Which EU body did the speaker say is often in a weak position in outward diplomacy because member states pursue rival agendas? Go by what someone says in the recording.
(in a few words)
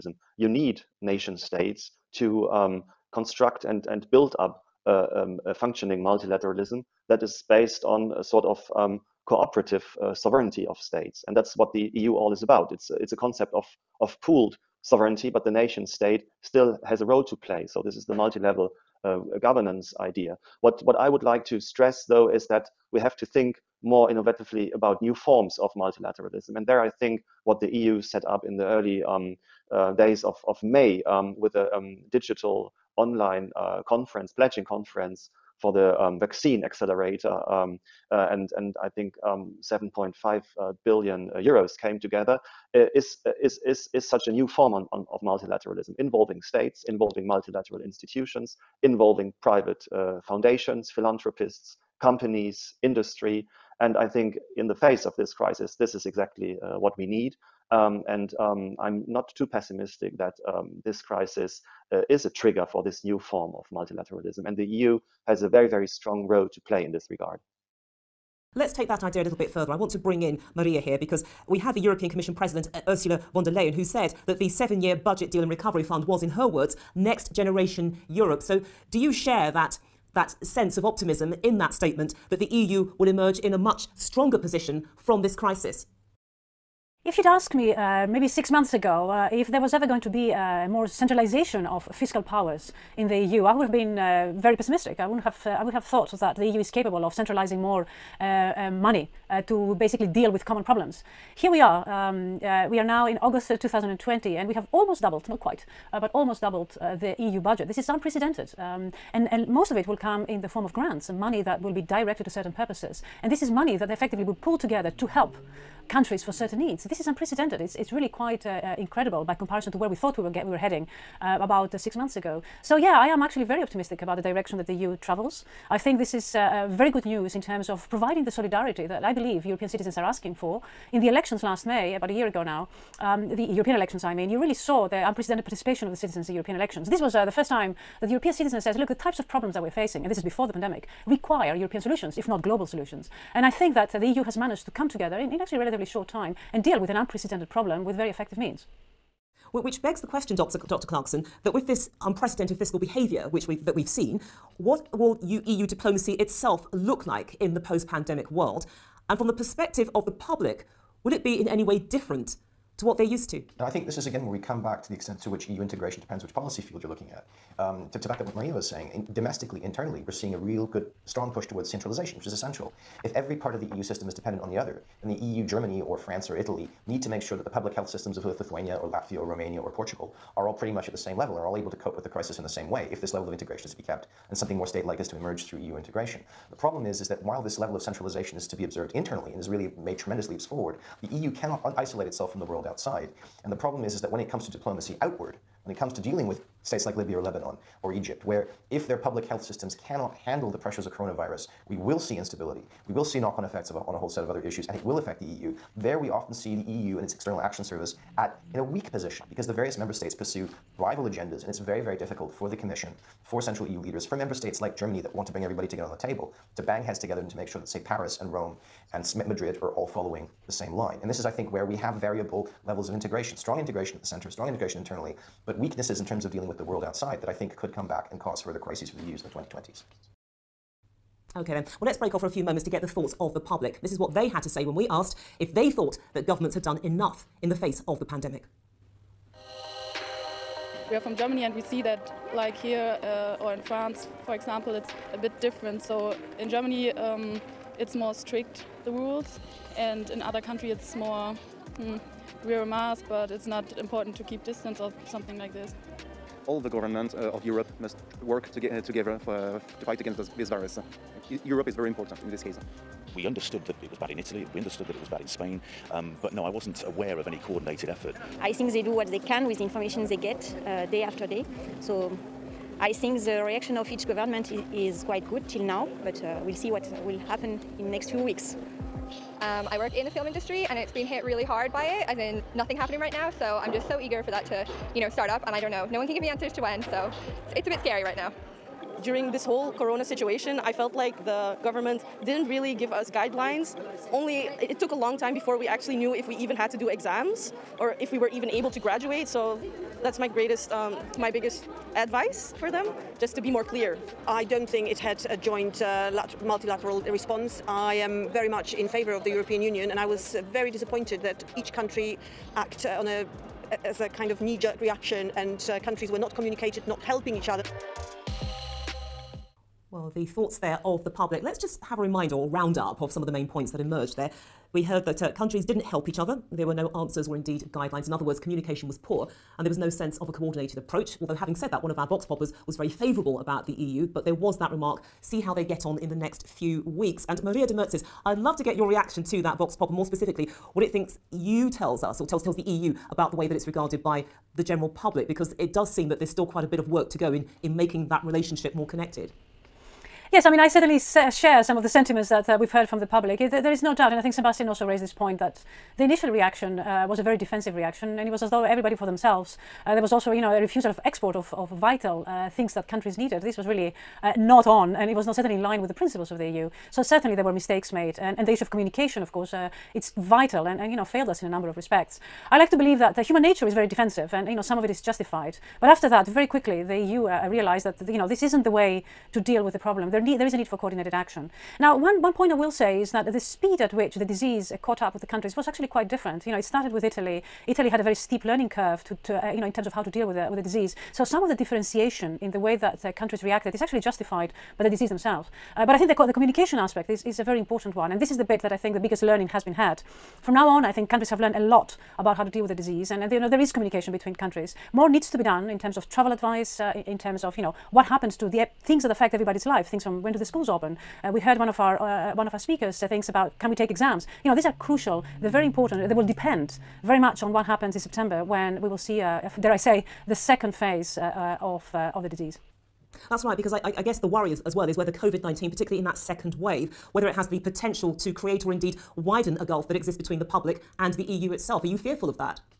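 External Action Service.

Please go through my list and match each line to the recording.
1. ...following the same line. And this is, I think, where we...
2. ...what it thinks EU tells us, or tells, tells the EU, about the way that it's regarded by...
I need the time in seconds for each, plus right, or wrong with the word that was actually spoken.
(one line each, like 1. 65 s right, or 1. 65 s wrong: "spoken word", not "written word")
1. 219 s right
2. 340 s right.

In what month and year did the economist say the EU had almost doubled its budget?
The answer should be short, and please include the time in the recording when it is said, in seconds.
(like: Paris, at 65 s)
August 2020, at 103 s.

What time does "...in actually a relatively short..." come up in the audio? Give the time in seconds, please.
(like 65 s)
145 s.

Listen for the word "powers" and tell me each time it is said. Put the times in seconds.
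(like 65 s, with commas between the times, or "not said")
92 s.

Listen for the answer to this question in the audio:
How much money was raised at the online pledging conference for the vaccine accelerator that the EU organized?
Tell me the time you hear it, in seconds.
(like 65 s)
39 s.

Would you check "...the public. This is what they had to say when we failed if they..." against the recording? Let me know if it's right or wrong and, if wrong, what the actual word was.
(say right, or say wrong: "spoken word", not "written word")
wrong: "asked", not "failed".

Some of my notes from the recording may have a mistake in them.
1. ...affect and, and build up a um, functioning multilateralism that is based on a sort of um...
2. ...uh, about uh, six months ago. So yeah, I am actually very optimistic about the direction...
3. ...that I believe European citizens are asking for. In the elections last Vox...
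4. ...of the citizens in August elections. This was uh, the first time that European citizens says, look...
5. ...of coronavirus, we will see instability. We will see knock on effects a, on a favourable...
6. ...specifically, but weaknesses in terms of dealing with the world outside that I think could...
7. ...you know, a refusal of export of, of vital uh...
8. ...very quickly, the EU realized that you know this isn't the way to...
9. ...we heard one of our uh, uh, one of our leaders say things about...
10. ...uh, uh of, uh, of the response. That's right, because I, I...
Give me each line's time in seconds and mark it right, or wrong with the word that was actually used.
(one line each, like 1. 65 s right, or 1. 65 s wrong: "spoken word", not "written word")
1. 3 s wrong: "construct", not "affect"
2. 121 s right
3. 128 s wrong: "May", not "Vox"
4. 135 s wrong: "European", not "August"
5. 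200 s wrong: "whole", not "favourable"
6. 224 s wrong: "internally", not "specifically"
7. 360 s right
8. 376 s right
9. 411 s wrong: "speakers", not "leaders"
10. 421 s wrong: "disease", not "response".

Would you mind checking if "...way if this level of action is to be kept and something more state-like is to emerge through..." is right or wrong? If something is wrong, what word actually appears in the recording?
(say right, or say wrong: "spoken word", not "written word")
wrong: "integration", not "action".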